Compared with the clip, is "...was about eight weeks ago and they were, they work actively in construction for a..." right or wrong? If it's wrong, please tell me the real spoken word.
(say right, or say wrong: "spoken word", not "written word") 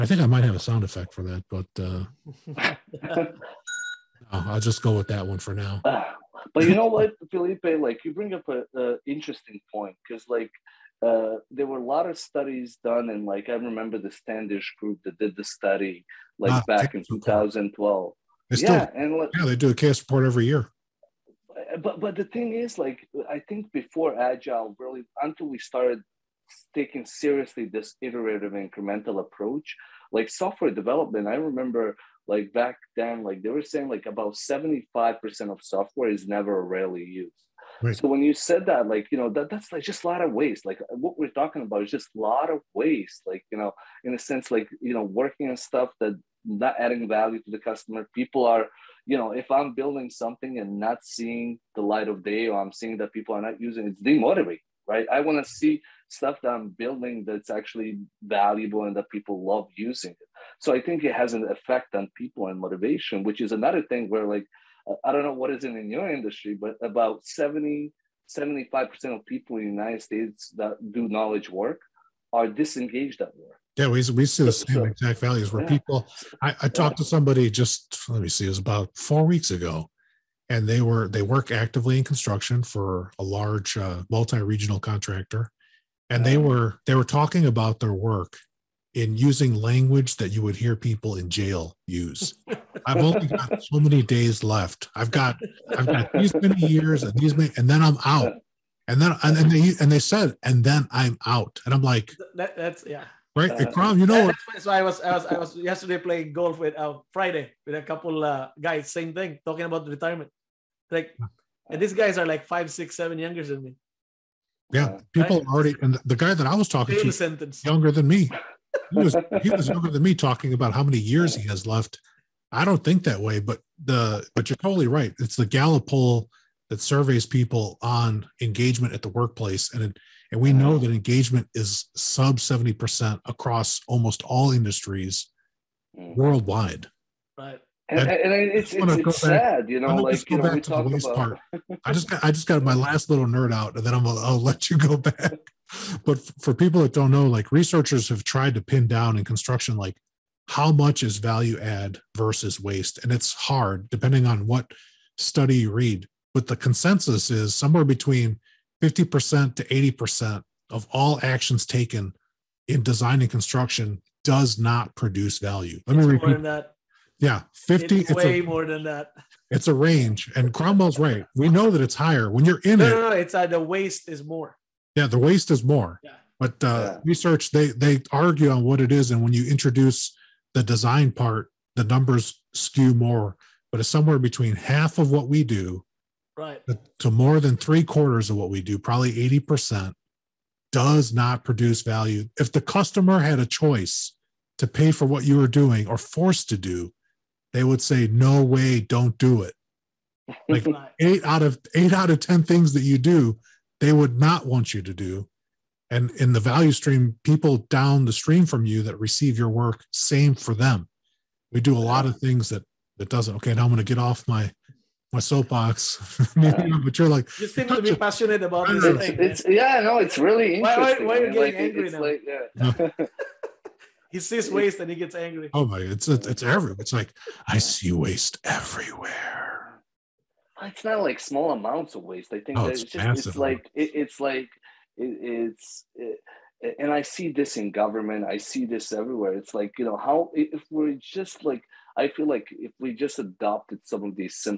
wrong: "four", not "eight".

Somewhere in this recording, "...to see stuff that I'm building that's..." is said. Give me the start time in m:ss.
0:55.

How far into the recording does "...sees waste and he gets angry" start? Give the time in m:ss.
3:44.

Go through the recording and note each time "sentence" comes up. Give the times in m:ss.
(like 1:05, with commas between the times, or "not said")
1:57.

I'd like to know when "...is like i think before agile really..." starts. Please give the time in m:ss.
0:22.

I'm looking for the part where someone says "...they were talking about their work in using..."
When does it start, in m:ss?
1:26.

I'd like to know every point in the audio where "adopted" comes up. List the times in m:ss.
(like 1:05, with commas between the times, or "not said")
4:03.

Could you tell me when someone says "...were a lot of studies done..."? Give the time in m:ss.
0:11.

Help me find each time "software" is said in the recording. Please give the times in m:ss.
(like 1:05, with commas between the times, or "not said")
0:30, 0:35.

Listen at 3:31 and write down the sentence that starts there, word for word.
We do a lot of things that that doesn't.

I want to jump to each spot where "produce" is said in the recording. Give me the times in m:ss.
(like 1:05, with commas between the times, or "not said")
2:44, 3:11.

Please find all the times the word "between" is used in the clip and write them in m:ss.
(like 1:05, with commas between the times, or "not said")
2:37, 3:04.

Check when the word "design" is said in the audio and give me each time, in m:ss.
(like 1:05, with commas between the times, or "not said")
2:42, 3:00.